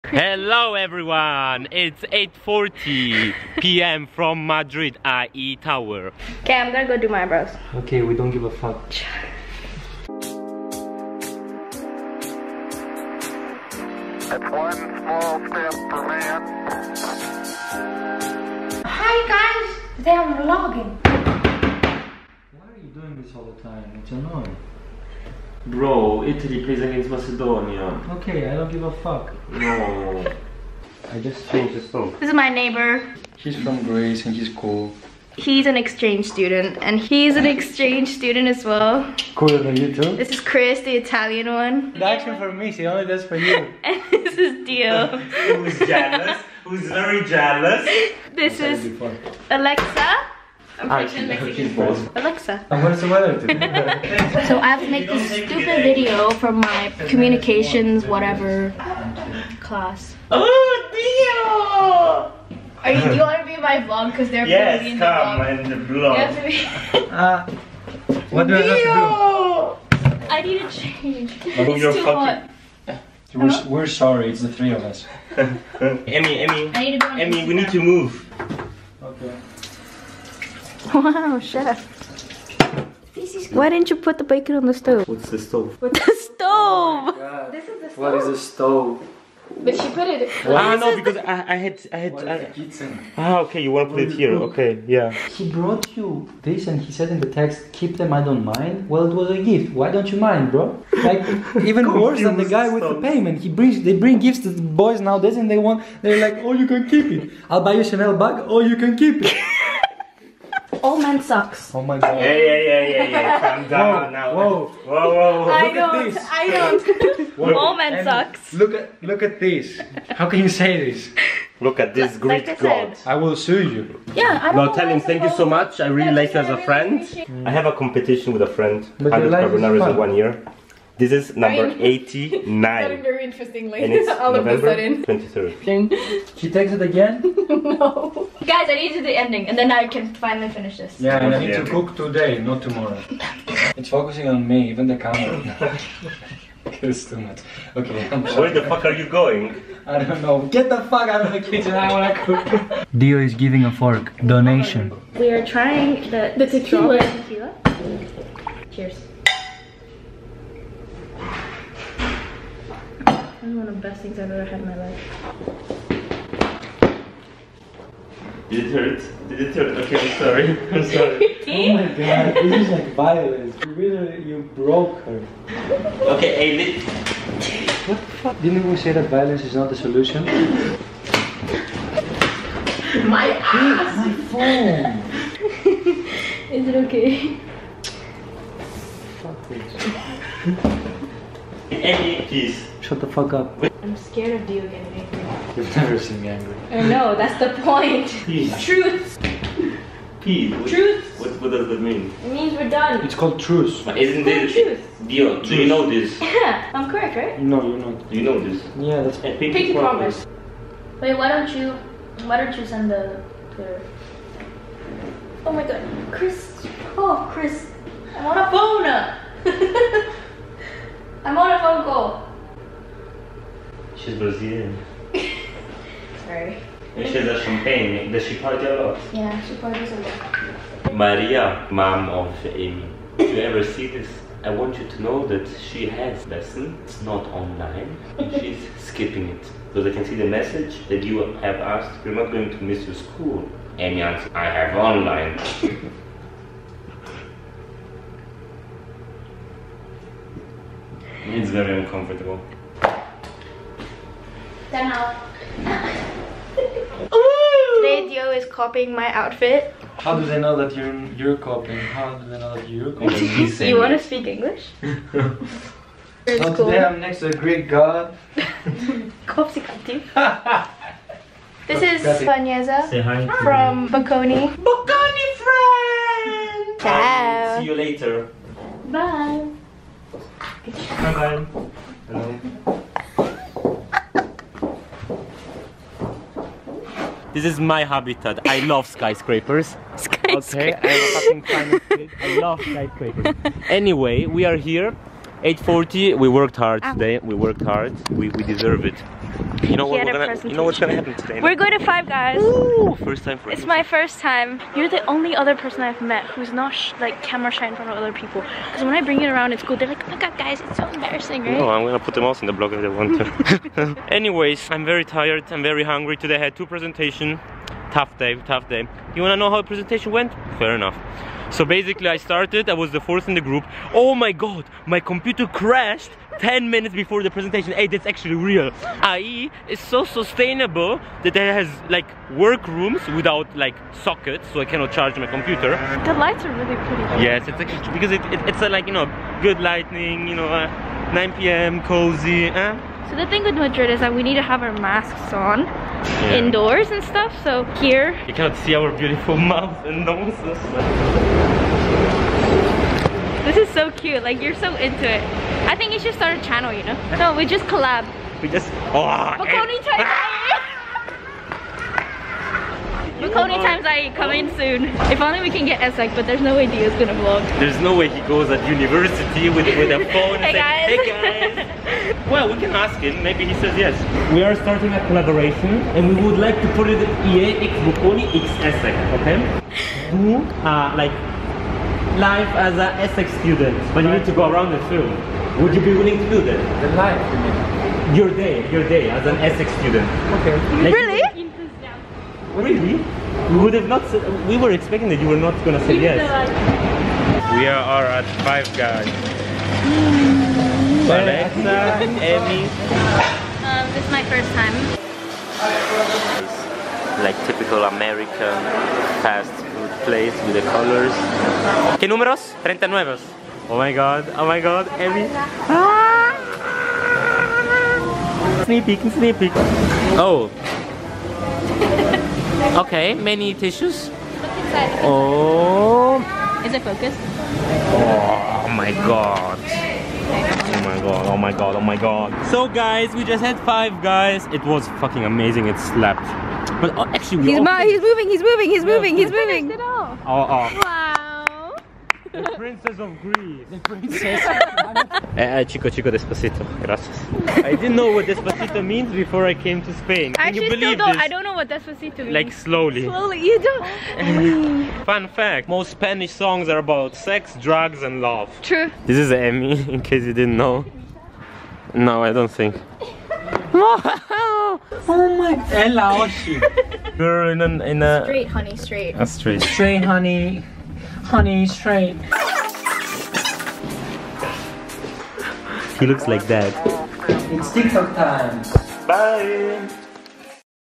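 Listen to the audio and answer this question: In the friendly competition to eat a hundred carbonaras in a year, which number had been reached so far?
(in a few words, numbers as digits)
89.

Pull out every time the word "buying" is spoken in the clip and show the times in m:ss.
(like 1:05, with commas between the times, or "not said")
not said.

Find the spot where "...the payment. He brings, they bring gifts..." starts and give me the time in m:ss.
1:42.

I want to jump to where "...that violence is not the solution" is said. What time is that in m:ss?
2:58.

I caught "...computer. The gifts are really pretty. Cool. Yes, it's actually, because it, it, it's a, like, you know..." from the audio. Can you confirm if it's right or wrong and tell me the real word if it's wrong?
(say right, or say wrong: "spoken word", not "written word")
wrong: "lights", not "gifts".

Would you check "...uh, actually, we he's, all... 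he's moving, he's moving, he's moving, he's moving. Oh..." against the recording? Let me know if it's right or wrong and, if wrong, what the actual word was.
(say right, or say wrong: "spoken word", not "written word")
right.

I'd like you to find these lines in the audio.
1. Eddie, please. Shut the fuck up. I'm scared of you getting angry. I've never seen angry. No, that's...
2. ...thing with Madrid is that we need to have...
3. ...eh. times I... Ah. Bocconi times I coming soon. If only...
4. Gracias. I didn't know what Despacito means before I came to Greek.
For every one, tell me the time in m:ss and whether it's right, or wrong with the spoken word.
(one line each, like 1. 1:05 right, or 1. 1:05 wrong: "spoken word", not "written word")
1. 3:11 right
2. 5:43 right
3. 5:59 right
4. 7:26 wrong: "Spain", not "Greek".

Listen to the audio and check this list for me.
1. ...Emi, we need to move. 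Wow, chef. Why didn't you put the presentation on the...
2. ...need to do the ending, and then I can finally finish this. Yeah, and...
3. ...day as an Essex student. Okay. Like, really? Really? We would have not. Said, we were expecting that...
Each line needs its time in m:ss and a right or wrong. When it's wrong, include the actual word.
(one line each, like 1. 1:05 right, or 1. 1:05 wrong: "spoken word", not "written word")
1. 1:16 wrong: "bacon", not "presentation"
2. 2:18 right
3. 6:28 right.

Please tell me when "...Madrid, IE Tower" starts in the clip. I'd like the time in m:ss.
0:04.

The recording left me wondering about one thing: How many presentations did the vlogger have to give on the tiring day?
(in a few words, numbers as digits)
2.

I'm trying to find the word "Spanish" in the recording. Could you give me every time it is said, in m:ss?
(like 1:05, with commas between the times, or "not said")
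7:35.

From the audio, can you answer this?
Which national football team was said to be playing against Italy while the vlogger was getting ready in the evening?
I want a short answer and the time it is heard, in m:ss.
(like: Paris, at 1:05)
Macedonia, at 0:27.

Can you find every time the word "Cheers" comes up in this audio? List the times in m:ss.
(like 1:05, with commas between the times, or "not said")
2:38.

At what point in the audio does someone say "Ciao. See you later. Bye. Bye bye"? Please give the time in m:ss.
4:36.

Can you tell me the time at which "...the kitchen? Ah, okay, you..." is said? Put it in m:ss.
1:32.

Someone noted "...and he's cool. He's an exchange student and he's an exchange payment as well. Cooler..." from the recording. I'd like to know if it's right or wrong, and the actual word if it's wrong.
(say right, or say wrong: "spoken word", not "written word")
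wrong: "student", not "payment".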